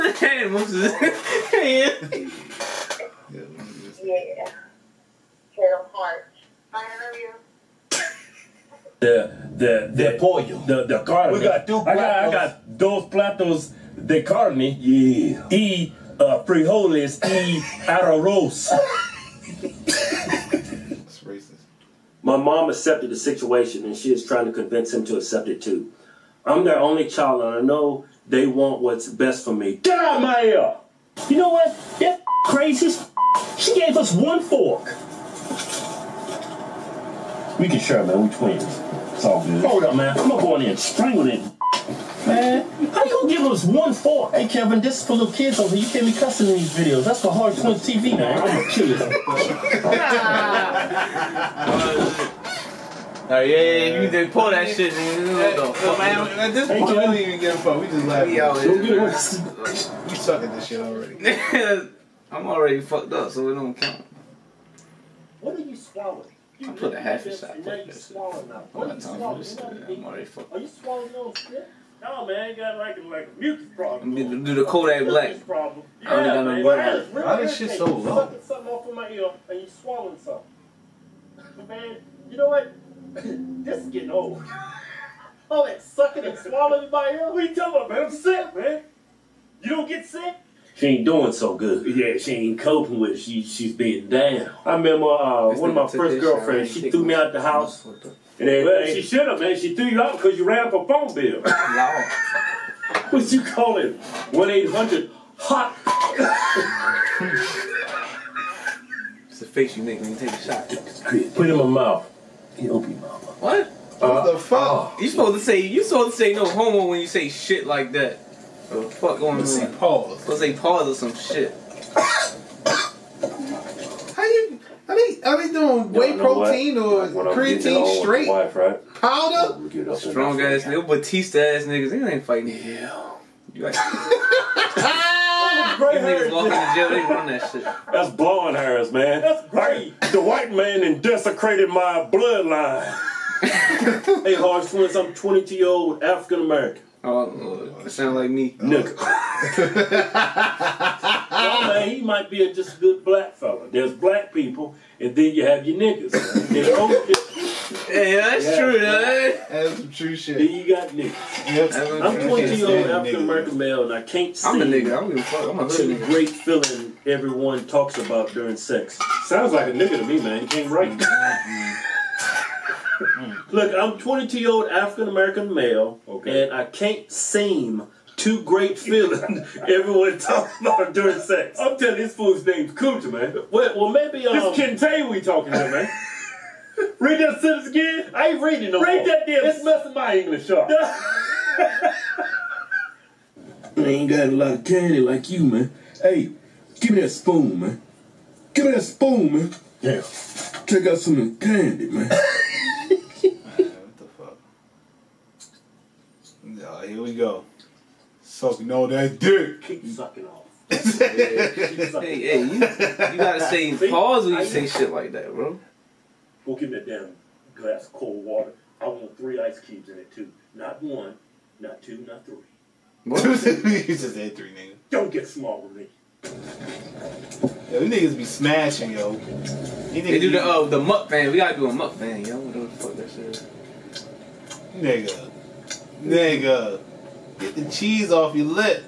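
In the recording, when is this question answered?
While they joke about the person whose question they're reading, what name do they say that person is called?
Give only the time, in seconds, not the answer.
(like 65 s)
182 s.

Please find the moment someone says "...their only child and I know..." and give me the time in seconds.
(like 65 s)
26 s.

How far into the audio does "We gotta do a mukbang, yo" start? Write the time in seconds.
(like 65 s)
231 s.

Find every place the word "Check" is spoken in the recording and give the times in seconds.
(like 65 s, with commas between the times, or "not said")
200 s.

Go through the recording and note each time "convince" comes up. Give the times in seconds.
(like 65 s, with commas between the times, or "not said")
24 s.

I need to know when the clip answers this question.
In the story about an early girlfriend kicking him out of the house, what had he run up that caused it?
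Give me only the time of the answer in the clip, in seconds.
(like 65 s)
100 s.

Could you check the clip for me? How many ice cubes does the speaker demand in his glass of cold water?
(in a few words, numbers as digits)
3.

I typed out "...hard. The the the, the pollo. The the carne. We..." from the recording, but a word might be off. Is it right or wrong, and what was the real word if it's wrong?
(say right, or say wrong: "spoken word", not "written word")
right.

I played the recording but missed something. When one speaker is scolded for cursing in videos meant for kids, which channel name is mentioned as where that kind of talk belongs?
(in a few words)
Hard Point TV.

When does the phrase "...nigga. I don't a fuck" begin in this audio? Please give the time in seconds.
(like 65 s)
164 s.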